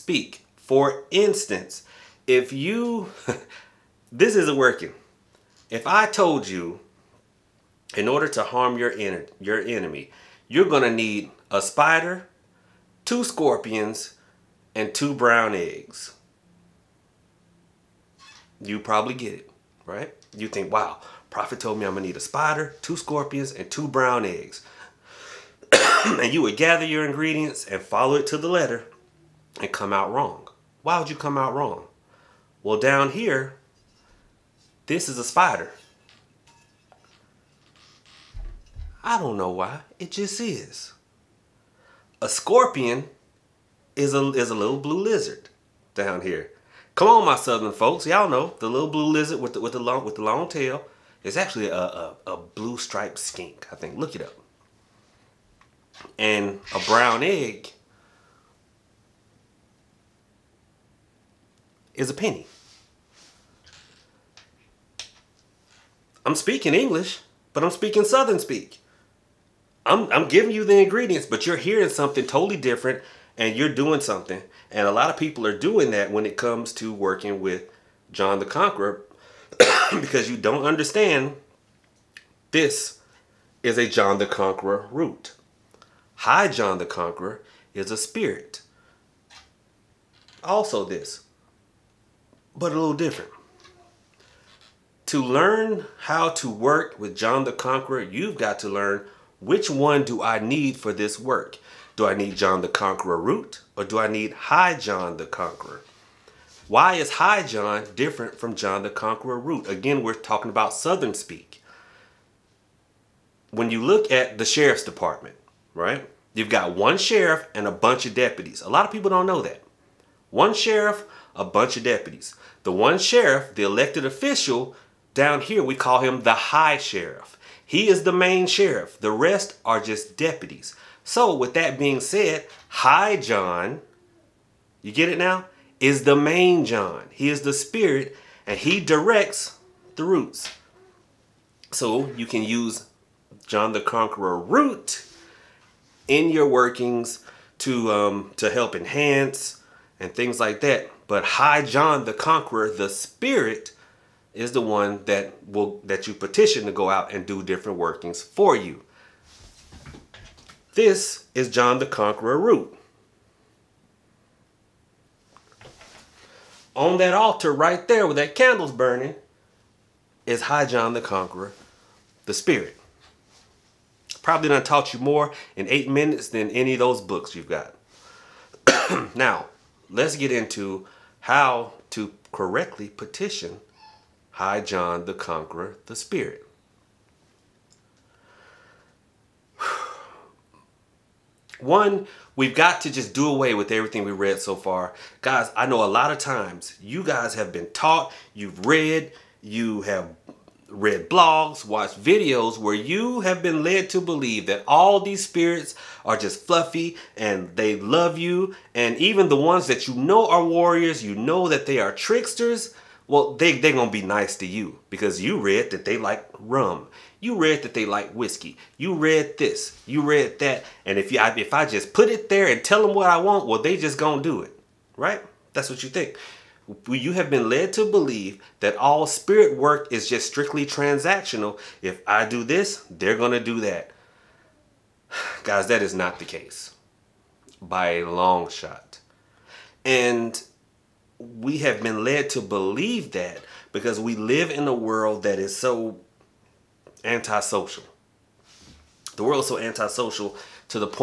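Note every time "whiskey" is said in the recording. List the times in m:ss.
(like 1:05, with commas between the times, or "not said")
3:38.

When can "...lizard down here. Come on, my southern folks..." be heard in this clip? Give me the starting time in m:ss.
0:44.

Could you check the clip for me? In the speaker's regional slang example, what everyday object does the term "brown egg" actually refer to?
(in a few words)
A penny.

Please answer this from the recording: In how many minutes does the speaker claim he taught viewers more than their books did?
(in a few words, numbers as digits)
8.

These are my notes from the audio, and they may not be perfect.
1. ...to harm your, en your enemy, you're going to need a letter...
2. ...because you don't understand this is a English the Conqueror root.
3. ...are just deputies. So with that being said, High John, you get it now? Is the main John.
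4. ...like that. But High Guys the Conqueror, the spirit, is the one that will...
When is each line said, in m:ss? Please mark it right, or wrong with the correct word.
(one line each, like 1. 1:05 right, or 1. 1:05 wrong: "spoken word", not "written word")
1. 0:08 wrong: "spider", not "letter"
2. 1:19 wrong: "John", not "English"
3. 2:09 right
4. 2:30 wrong: "John", not "Guys".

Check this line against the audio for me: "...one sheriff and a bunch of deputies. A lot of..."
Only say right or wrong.
right.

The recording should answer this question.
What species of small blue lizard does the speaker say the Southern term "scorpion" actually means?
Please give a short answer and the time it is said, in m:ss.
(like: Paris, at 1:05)
Blue striped skink, at 0:52.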